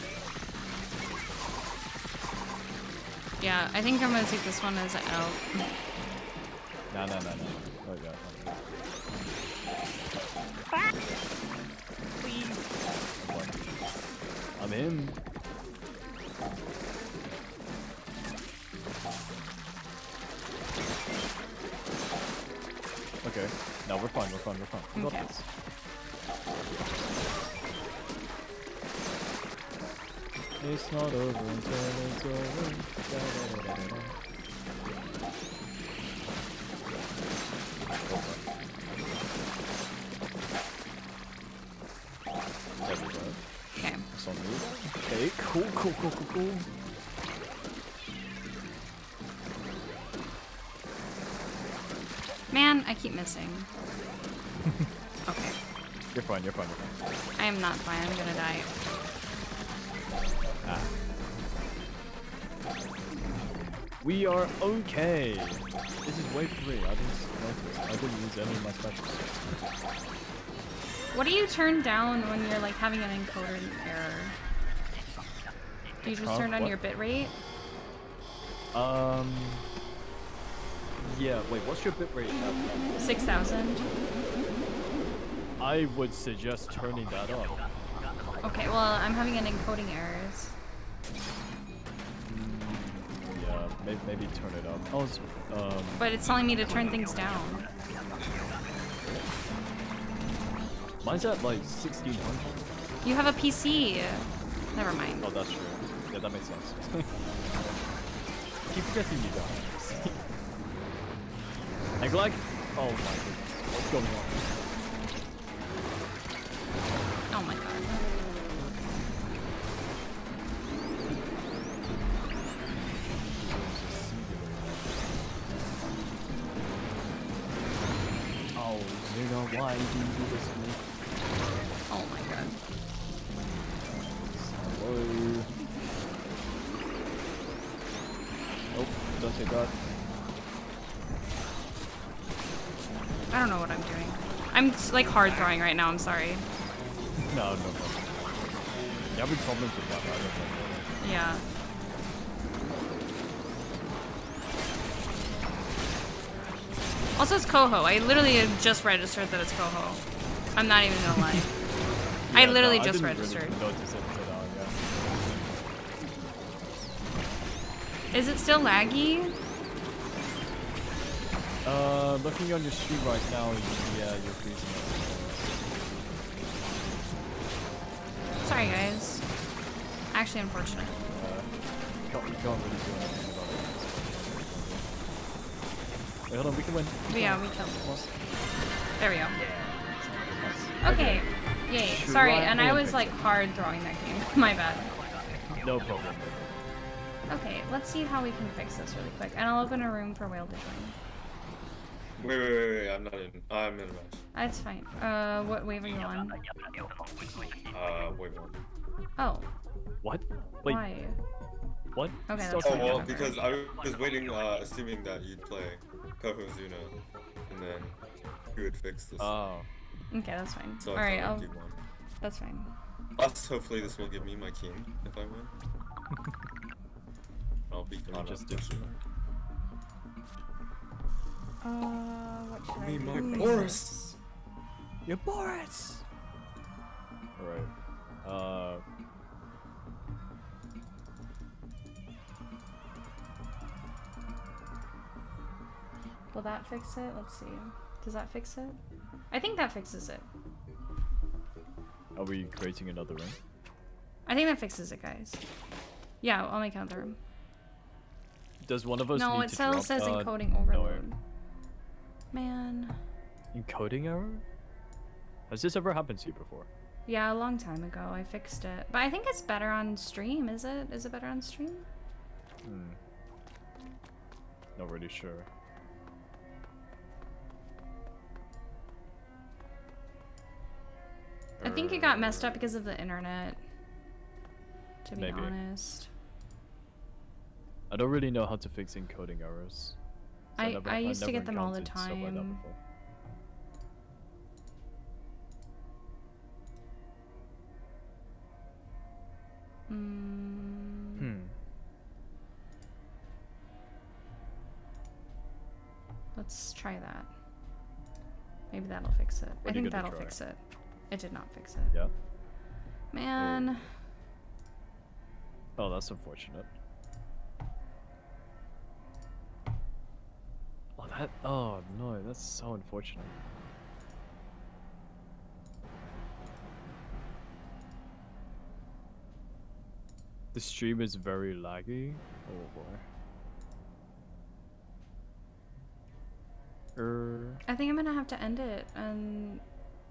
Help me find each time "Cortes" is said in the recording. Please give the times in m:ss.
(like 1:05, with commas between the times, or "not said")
not said.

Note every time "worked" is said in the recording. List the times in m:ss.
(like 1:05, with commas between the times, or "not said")
not said.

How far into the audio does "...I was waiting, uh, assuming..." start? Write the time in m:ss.
3:33.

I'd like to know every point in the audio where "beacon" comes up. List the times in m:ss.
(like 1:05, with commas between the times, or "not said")
not said.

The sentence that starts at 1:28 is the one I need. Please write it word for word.
Okay, well, I'm having an encoding errors.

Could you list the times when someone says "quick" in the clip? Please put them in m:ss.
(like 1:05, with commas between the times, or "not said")
3:19.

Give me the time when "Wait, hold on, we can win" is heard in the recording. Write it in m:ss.
3:06.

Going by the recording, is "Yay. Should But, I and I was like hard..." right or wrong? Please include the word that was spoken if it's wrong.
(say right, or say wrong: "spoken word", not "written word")
wrong: "Sorry", not "But".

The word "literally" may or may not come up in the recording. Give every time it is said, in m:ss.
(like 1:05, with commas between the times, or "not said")
2:37, 2:42.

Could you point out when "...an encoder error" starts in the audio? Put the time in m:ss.
1:13.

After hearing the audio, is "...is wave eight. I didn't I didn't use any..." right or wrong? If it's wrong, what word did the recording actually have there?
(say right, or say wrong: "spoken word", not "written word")
wrong: "three", not "eight".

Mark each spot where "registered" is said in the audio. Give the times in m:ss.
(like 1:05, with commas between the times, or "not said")
2:38, 2:43.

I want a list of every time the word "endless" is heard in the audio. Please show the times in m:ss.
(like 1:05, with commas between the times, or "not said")
not said.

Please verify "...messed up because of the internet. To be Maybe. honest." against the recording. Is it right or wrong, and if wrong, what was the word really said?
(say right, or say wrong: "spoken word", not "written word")
right.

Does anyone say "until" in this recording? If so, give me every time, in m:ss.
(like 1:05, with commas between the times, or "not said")
0:31.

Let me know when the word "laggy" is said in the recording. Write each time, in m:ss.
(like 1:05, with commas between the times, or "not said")
2:48, 5:31.